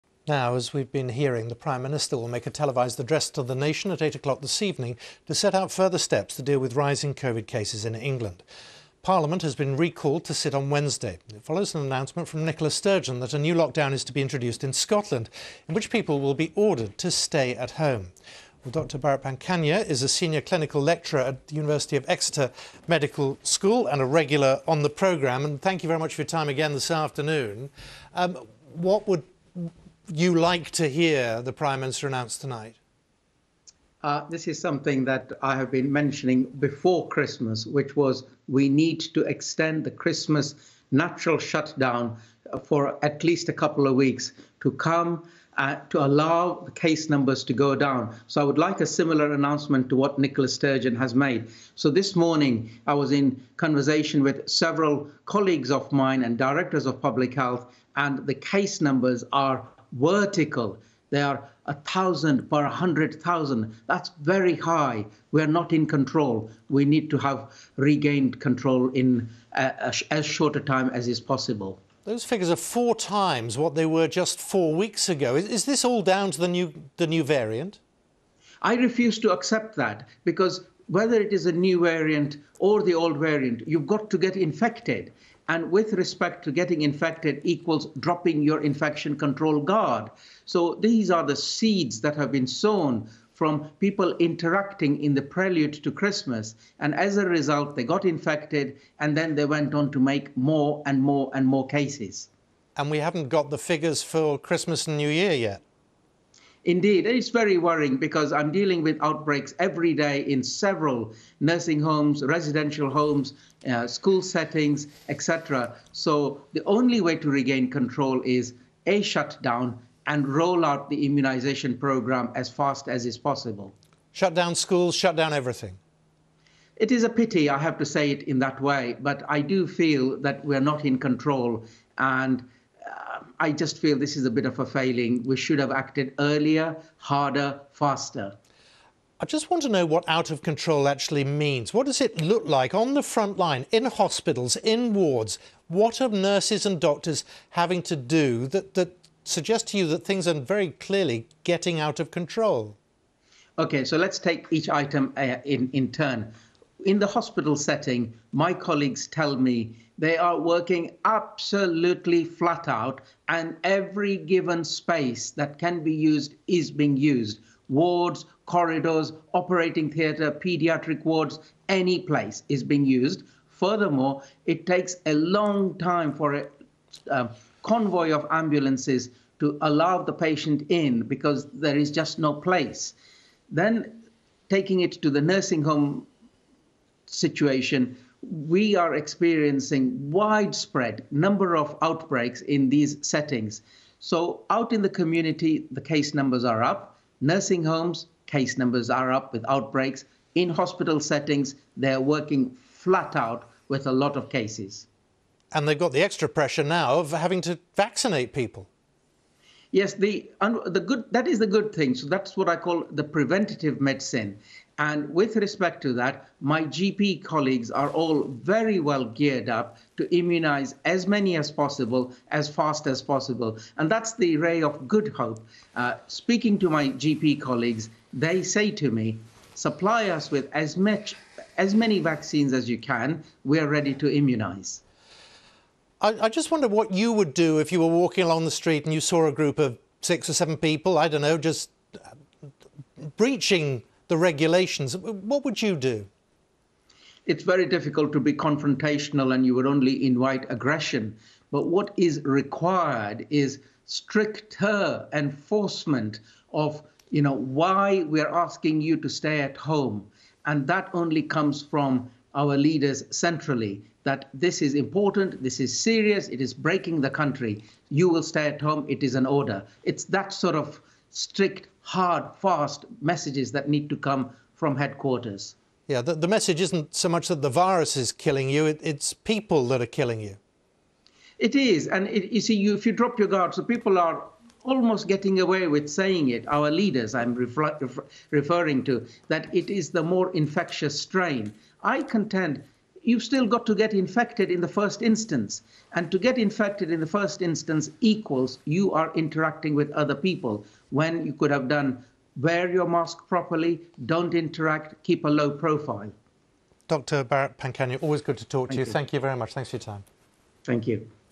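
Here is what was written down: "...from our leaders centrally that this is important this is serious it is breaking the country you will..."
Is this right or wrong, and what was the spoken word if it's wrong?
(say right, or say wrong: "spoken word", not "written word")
right.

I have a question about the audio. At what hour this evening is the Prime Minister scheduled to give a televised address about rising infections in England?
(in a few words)
8 o'clock.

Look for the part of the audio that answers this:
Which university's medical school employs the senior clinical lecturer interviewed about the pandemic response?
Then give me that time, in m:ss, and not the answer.
0:21.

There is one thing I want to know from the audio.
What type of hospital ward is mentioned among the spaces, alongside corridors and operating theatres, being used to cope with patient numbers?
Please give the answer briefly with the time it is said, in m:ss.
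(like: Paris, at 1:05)
Pediatric wards, at 2:50.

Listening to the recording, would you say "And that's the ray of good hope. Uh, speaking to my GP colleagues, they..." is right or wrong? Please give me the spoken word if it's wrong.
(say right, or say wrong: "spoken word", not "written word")
right.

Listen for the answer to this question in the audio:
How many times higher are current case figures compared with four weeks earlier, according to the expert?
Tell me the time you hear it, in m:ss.
1:12.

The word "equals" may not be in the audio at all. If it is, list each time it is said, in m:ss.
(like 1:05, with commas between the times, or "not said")
1:27, 4:58.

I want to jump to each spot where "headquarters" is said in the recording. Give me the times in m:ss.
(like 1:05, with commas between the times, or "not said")
4:34.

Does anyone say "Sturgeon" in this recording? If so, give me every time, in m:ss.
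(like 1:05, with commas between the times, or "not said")
0:12, 0:50.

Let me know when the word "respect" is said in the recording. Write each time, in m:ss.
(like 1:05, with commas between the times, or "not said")
1:25, 3:35.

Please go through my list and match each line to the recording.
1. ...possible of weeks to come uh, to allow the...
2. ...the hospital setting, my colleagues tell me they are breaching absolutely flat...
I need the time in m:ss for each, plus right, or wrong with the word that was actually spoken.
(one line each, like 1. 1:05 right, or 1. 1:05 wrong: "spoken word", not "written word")
1. 0:43 wrong: "couple", not "possible"
2. 2:36 wrong: "working", not "breaching".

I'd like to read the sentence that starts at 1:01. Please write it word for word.
They are a thousand per hundred thousand.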